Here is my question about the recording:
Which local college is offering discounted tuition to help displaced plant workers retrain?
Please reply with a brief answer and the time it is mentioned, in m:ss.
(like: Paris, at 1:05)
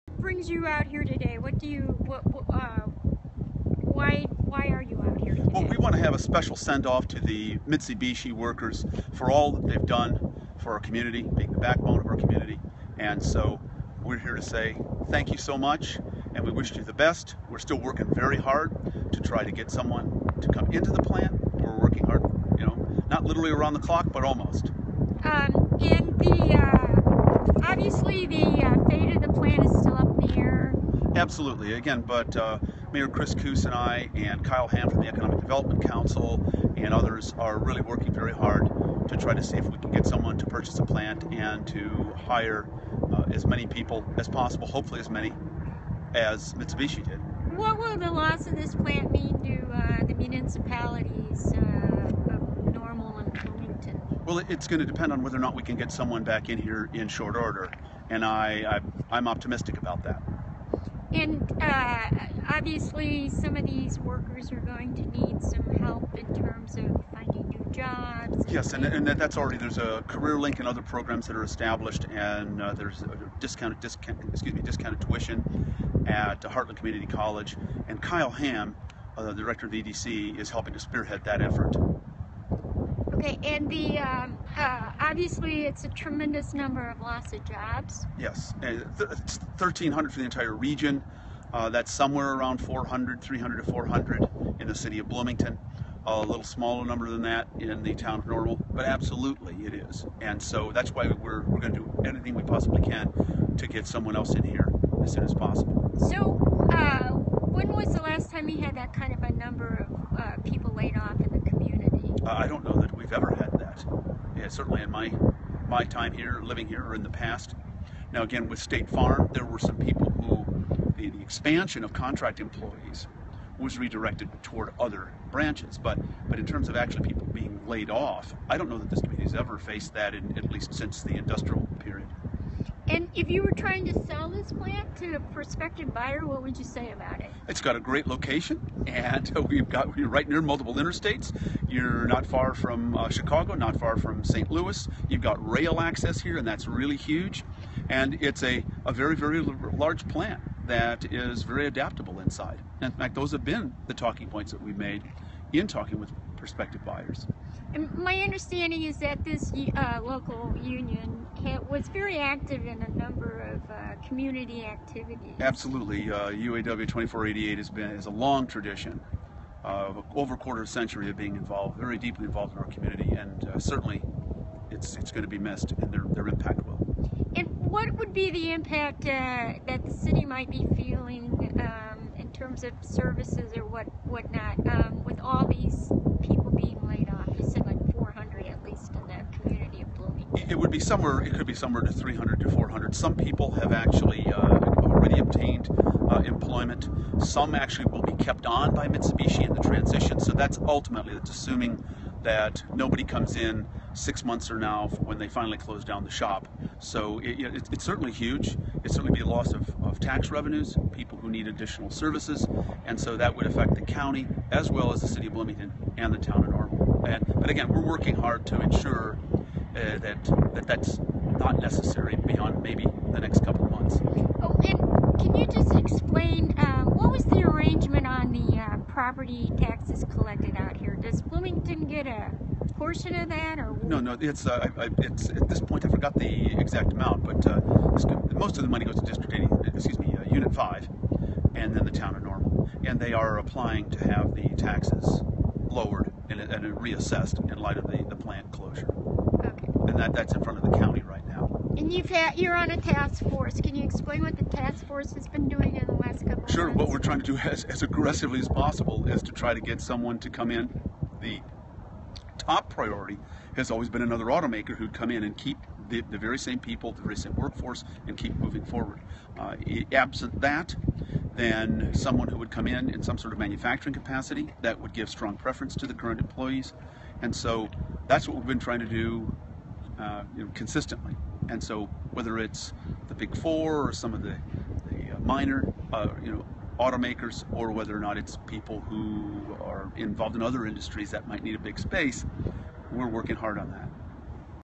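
Heartland Community College, at 1:16.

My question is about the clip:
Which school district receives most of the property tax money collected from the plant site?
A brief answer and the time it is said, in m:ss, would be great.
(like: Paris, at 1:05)
Unit 5, at 4:00.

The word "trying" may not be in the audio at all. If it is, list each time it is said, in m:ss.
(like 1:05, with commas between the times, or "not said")
2:13, 4:16, 4:38.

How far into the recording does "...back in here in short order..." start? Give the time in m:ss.
0:56.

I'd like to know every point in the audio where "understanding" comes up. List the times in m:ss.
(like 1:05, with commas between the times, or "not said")
2:38.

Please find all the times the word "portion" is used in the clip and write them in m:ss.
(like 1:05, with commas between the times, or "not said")
3:52.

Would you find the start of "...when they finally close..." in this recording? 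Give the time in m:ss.
3:24.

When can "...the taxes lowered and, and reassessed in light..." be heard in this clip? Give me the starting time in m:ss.
4:04.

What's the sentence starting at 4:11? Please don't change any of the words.
And you've had, you're on a task force.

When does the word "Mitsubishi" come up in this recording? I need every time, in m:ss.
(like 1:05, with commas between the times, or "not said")
0:07, 0:46, 3:18.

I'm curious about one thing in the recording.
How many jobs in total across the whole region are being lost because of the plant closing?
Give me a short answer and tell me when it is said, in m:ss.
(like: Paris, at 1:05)
1,300, at 1:28.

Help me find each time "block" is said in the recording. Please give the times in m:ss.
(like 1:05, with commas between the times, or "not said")
not said.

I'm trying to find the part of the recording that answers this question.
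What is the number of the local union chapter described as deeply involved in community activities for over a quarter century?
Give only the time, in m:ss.
2:46.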